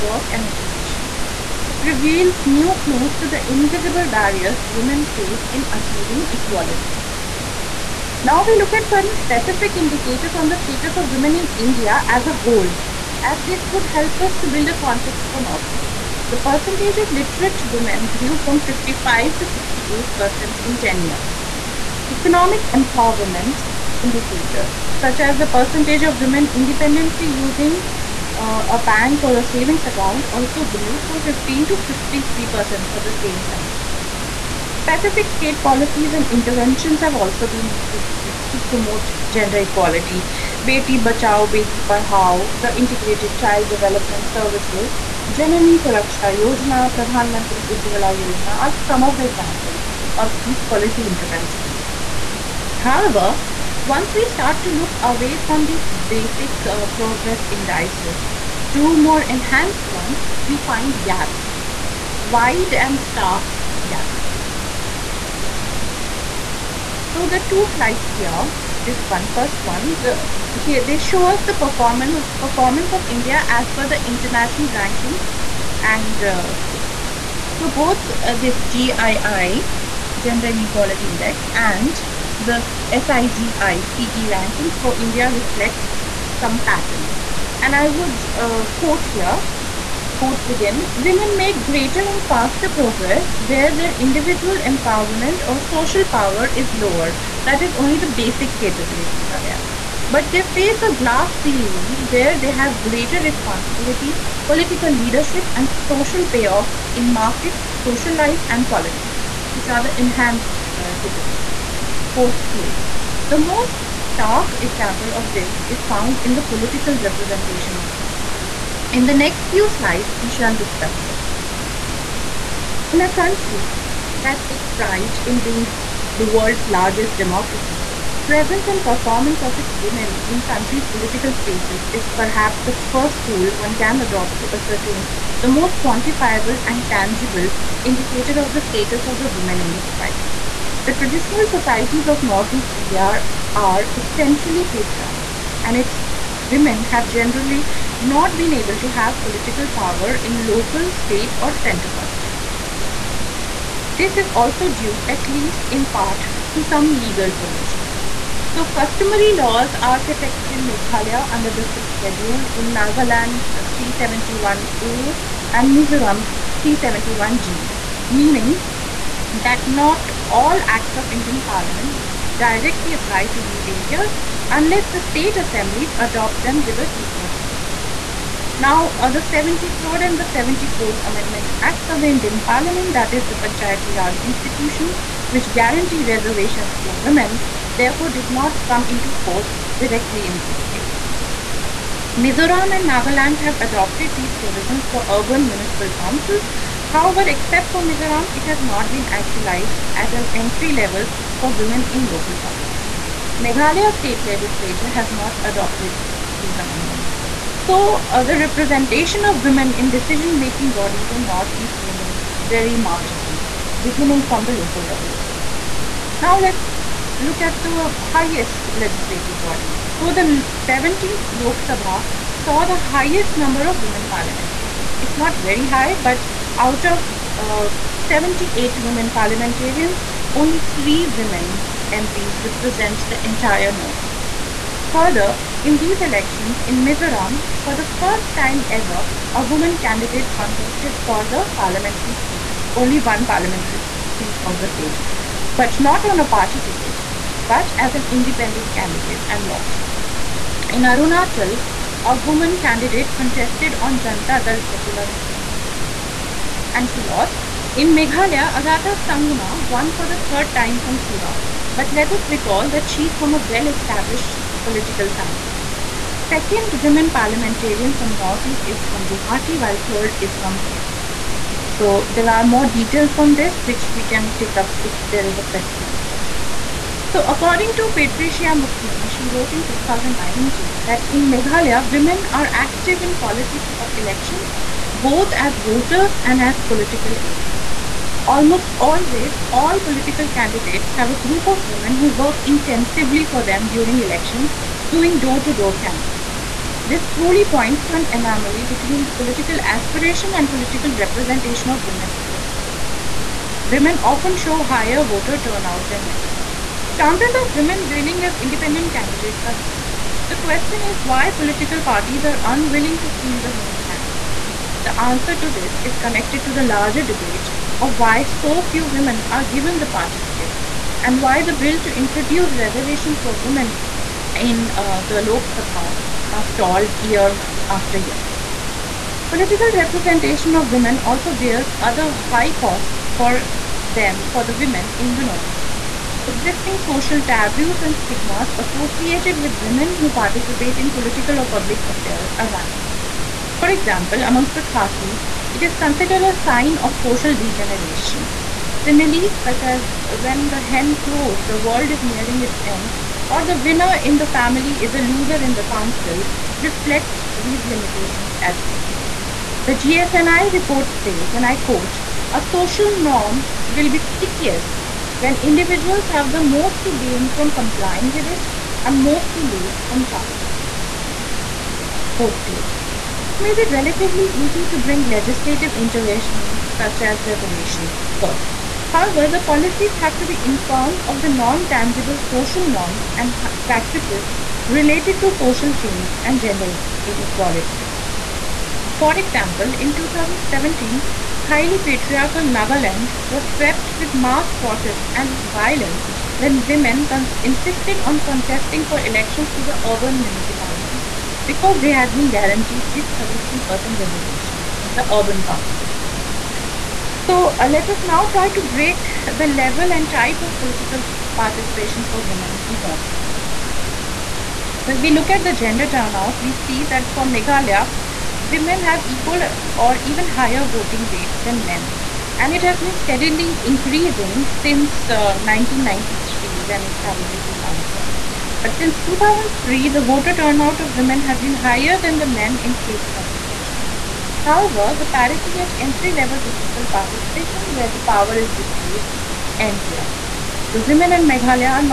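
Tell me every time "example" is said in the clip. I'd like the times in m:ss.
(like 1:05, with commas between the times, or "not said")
0:49, 1:54, 5:43, 6:29.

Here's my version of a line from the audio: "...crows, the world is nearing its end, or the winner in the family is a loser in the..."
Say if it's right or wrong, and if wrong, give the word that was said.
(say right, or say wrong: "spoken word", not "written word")
right.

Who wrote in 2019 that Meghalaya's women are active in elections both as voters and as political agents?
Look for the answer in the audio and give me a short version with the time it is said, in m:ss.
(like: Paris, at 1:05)
Patricia Mukim, at 4:37.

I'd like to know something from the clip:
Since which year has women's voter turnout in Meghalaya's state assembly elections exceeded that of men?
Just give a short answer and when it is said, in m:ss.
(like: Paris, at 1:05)
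2003, at 7:08.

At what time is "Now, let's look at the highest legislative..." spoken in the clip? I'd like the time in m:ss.
3:36.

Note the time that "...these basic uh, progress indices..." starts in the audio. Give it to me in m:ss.
0:55.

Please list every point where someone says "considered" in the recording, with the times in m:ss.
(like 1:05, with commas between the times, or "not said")
5:45.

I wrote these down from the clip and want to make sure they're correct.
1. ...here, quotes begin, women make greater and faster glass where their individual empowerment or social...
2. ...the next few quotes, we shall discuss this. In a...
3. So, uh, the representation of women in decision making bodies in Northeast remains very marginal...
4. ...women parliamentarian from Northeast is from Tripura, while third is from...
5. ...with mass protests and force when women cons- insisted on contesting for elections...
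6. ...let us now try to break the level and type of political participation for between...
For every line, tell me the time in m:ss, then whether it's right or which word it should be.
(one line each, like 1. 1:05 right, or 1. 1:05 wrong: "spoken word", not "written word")
1. 1:29 wrong: "progress", not "glass"
2. 1:59 wrong: "slides", not "quotes"
3. 3:27 right
4. 4:26 wrong: "Guwahati", not "Tripura"
5. 6:33 wrong: "violence", not "force"
6. 6:47 wrong: "women", not "between".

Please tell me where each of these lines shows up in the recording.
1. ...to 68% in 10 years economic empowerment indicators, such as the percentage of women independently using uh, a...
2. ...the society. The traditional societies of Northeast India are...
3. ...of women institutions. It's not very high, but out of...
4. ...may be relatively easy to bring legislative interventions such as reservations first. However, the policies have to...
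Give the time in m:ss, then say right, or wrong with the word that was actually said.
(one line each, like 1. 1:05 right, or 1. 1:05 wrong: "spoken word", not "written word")
1. 0:19 right
2. 2:19 right
3. 3:43 wrong: "parliamentarians", not "institutions"
4. 6:13 right.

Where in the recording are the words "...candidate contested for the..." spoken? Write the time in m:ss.
3:59.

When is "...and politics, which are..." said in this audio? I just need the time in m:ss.
1:48.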